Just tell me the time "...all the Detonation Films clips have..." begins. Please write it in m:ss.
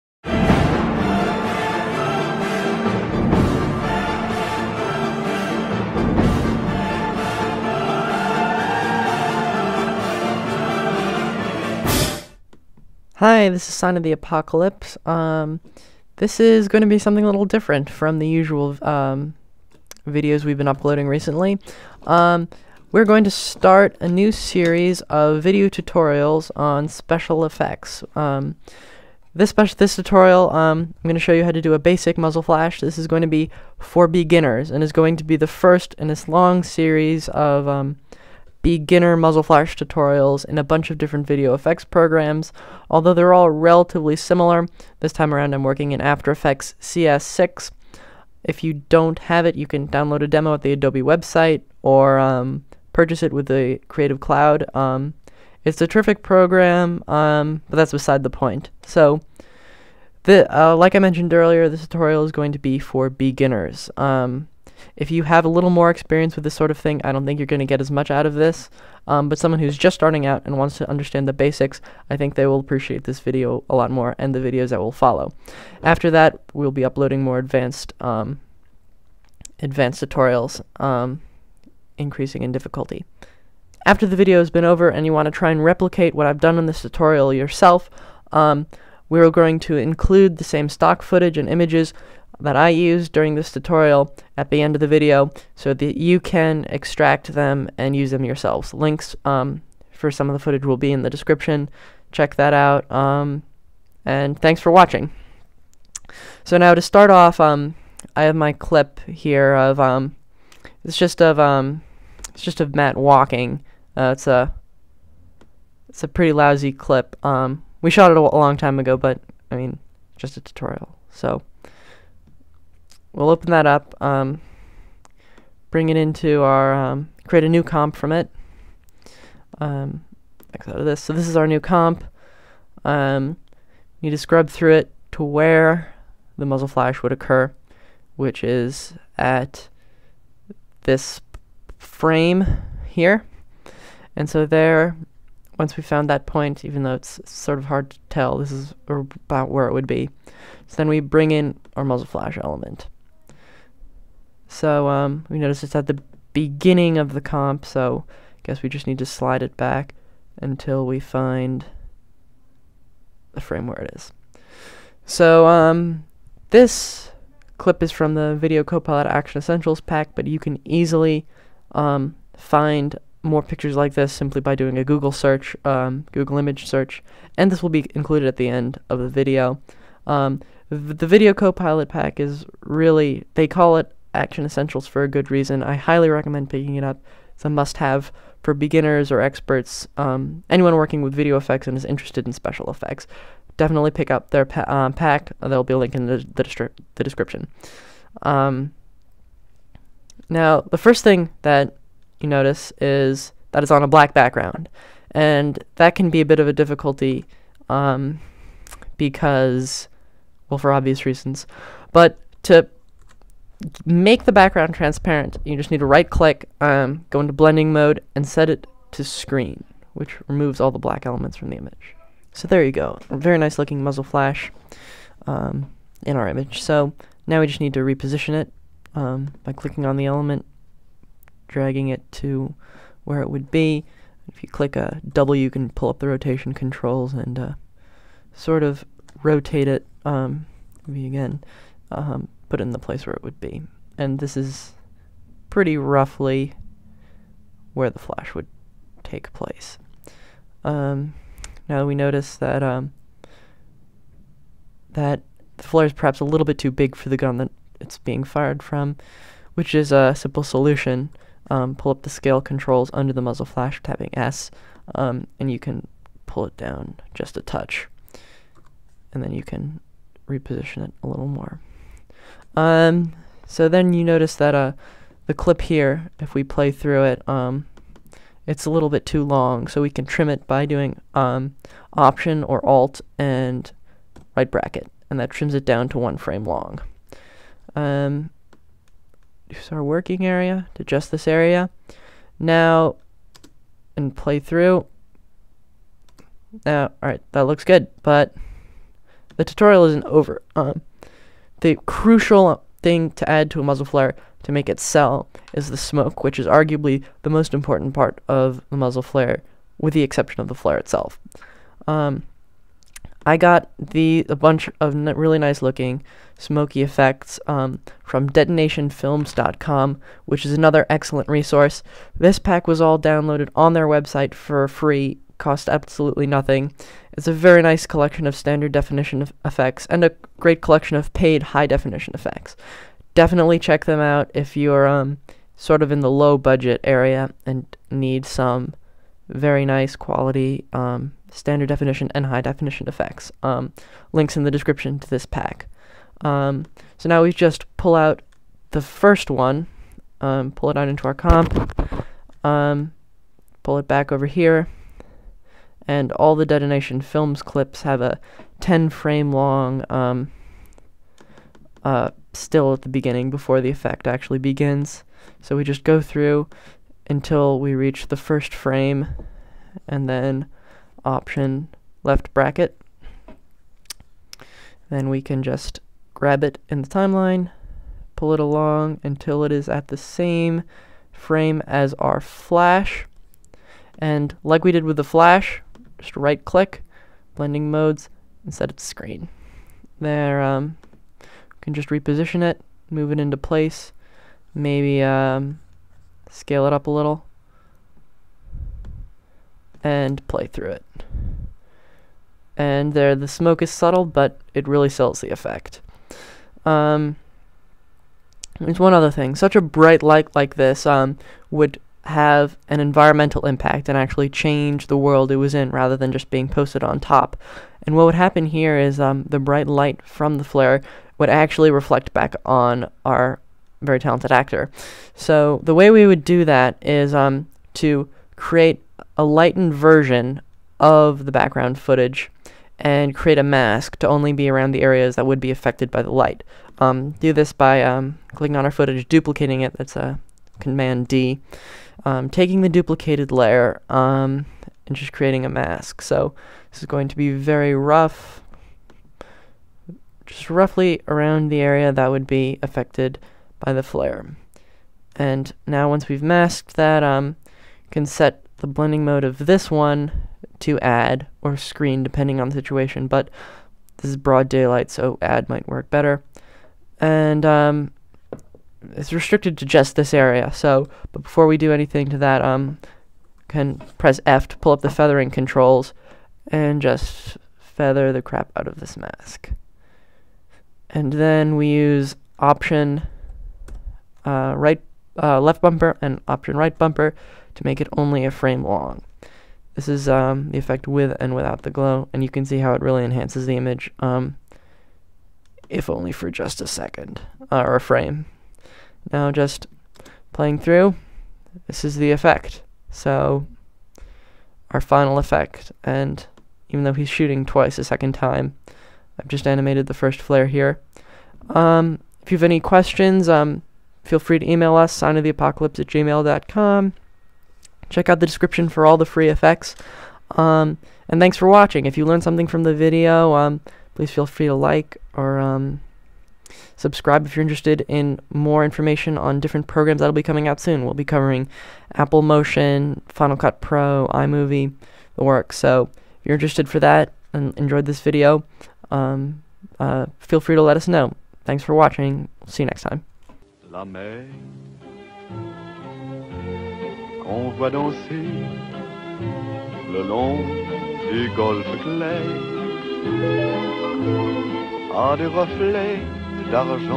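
5:56.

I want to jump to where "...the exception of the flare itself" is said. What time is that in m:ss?
5:09.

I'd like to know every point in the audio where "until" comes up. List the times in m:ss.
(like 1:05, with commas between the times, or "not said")
2:40, 6:07, 6:19.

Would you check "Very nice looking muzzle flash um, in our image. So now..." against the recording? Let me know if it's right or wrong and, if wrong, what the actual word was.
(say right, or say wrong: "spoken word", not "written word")
right.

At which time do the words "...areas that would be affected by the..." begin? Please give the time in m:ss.
7:14.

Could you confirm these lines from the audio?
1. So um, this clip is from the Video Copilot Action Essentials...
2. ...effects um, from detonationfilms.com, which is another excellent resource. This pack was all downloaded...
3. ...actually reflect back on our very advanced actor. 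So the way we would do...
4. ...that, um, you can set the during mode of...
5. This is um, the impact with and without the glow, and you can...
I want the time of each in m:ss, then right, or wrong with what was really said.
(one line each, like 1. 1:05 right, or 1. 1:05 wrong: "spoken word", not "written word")
1. 2:45 right
2. 5:16 right
3. 7:01 wrong: "talented", not "advanced"
4. 7:36 wrong: "blending", not "during"
5. 8:09 wrong: "effect", not "impact".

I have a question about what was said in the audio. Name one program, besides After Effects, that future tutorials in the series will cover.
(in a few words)
Apple Motion.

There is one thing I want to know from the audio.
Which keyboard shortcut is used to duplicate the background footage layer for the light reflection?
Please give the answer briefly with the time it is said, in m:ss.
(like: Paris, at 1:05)
Command D, at 7:20.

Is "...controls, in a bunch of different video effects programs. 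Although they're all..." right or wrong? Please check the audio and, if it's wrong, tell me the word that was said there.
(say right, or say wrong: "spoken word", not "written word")
wrong: "tutorials", not "controls".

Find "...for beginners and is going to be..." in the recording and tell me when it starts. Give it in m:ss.
0:33.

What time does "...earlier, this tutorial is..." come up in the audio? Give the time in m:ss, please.
1:01.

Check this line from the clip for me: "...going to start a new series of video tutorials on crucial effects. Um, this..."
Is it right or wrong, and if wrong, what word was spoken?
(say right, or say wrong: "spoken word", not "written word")
wrong: "special", not "crucial".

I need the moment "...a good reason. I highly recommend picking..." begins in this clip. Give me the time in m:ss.
3:05.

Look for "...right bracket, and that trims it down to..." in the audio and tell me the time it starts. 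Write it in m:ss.
4:44.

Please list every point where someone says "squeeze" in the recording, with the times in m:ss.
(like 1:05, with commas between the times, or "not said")
not said.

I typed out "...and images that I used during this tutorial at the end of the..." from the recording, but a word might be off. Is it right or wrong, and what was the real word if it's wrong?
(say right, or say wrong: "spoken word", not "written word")
right.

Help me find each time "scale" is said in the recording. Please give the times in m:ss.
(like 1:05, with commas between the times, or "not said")
4:22, 6:36.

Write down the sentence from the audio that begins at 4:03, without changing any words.
And this is pretty roughly where the flash would take place.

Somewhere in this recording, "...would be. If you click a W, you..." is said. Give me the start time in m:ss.
3:53.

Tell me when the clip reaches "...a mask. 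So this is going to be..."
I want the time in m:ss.
7:25.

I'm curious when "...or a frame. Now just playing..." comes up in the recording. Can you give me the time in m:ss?
8:17.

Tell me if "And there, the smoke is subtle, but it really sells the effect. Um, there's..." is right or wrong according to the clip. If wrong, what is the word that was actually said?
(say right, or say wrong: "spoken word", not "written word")
right.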